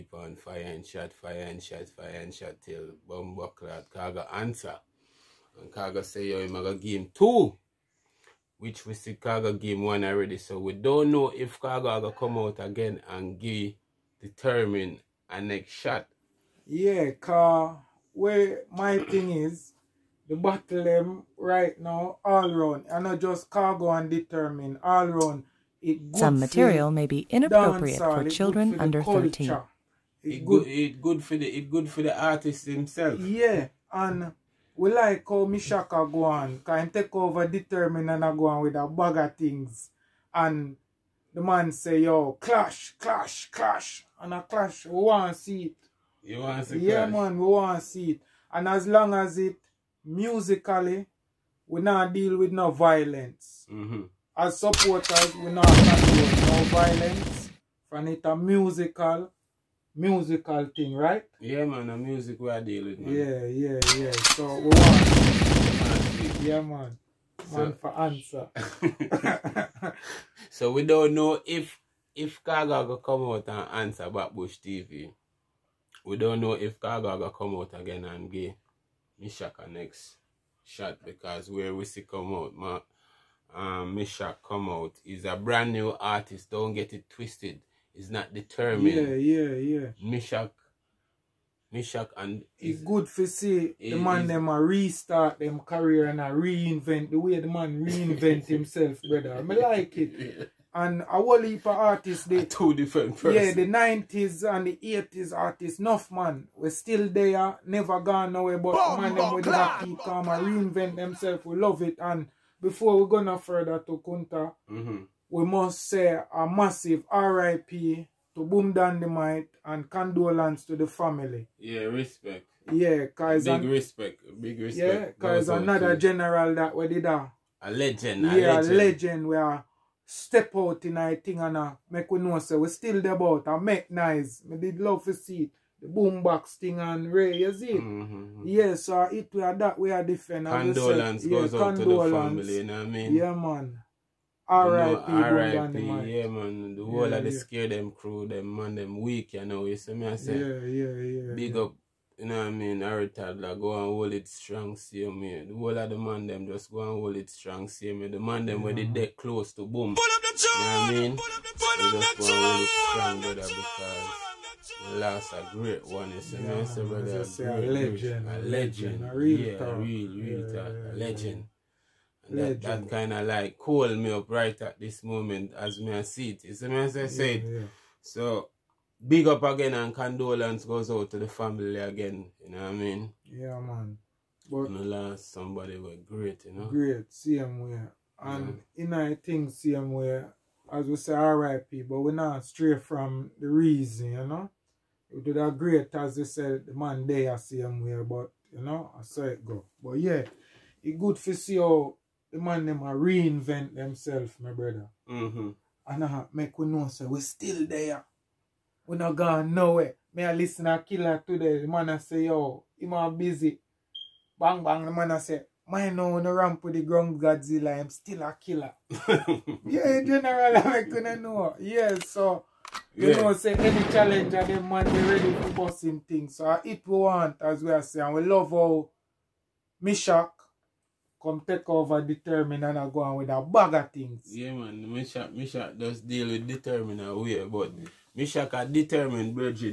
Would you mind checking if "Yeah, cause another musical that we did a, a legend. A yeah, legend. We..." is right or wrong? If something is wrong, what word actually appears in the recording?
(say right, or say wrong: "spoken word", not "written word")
wrong: "general", not "musical".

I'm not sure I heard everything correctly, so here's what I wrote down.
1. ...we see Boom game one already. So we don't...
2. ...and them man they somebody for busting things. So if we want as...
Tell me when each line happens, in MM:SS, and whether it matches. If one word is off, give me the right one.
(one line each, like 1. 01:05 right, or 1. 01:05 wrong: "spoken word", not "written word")
1. 00:08 wrong: "Khago", not "Boom"
2. 03:44 wrong: "ready", not "somebody".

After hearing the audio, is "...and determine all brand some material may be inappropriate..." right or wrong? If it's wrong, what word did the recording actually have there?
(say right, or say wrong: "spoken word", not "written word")
wrong: "round", not "brand".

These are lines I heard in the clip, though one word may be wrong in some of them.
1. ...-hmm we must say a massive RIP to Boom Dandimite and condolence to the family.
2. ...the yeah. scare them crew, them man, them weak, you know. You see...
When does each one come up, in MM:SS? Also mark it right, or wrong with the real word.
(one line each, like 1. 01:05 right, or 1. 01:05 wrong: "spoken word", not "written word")
1. 01:54 right
2. 02:27 right.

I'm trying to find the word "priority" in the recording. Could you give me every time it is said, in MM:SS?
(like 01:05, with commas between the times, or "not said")
not said.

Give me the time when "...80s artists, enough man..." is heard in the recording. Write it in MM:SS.
01:44.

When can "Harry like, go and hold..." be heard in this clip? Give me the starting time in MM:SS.
02:32.